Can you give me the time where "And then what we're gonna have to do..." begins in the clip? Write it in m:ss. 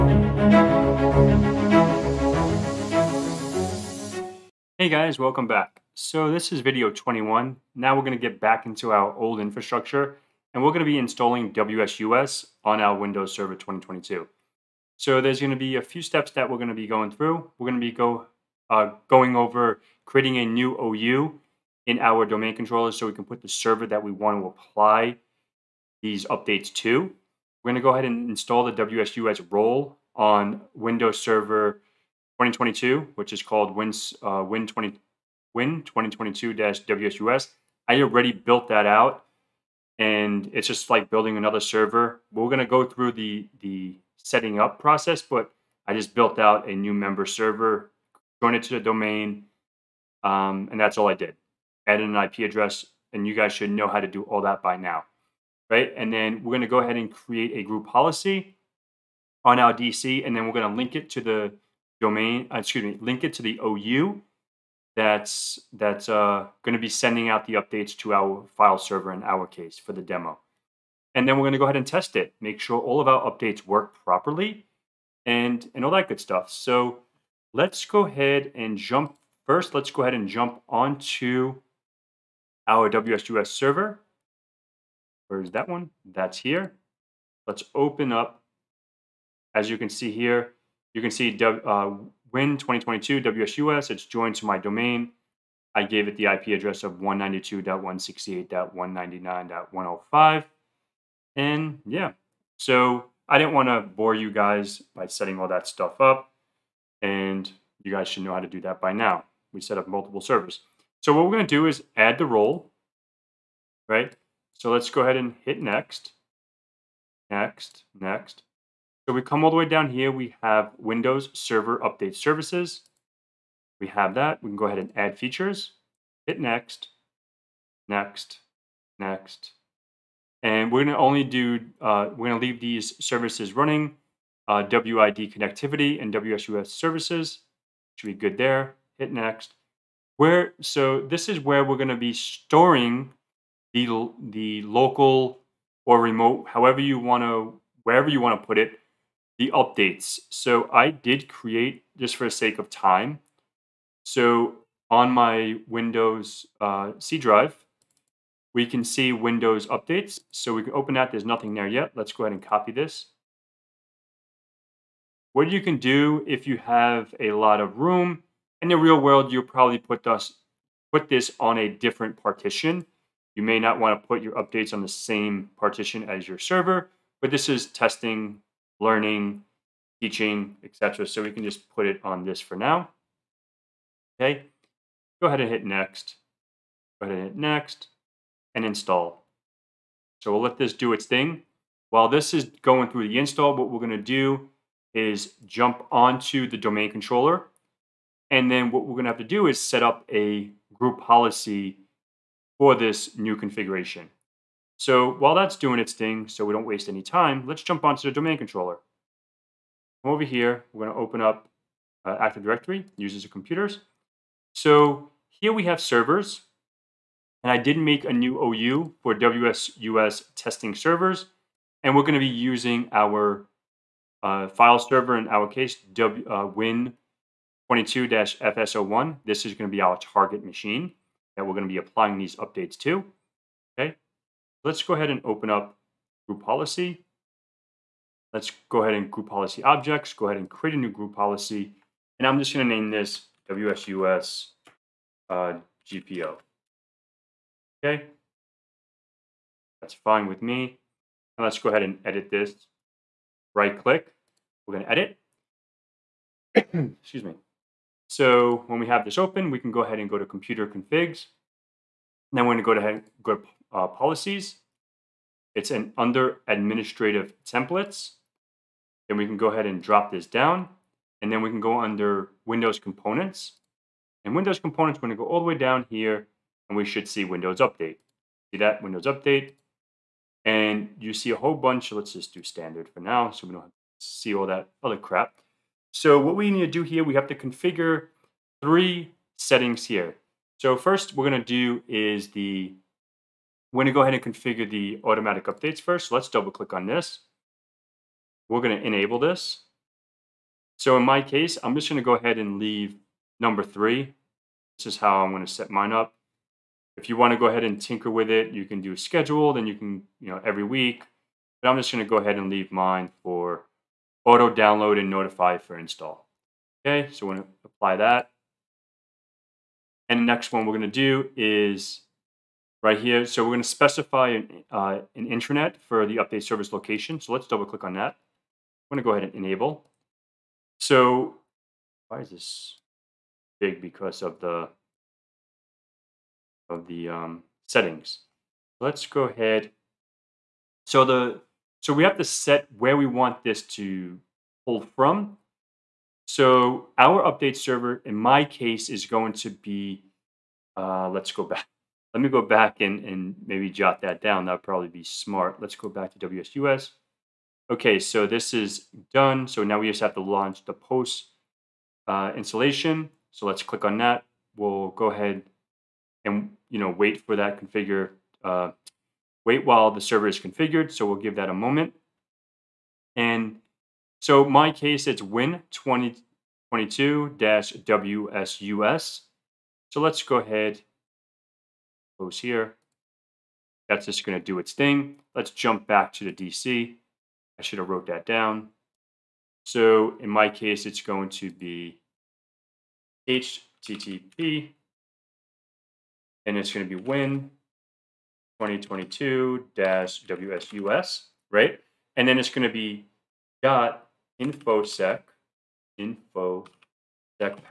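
3:18.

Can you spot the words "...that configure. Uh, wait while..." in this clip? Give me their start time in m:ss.
6:07.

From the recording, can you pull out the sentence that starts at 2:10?
And we're gonna only do, uh, we're gonna leave these services running, uh, WID connectivity and WSUS services.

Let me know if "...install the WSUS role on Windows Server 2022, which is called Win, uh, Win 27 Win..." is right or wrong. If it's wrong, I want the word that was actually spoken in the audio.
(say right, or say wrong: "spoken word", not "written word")
wrong: "20", not "27".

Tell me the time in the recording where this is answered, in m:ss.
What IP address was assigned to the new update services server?
1:36.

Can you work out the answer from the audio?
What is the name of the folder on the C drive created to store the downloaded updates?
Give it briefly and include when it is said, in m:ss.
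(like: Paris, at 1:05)
Windows updates, at 2:39.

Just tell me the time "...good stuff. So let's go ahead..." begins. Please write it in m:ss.
1:16.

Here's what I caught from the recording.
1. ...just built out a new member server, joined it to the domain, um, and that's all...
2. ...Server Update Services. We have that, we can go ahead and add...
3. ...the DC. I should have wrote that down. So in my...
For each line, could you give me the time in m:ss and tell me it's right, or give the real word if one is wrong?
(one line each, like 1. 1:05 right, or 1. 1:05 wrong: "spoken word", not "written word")
1. 0:45 right
2. 2:01 right
3. 6:26 right.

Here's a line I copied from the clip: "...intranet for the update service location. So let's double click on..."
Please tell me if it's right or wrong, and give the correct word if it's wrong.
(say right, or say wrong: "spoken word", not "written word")
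right.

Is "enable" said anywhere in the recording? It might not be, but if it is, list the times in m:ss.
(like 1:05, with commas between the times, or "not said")
4:58, 5:29.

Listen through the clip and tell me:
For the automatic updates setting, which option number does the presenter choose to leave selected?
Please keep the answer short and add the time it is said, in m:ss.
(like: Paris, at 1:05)
3, at 5:03.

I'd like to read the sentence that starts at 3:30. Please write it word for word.
Over here, we're going to open up uh, Active Directory, users and computers.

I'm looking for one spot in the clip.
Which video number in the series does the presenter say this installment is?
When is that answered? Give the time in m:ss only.
0:06.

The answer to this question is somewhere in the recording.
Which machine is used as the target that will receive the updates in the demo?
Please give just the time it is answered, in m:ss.
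3:46.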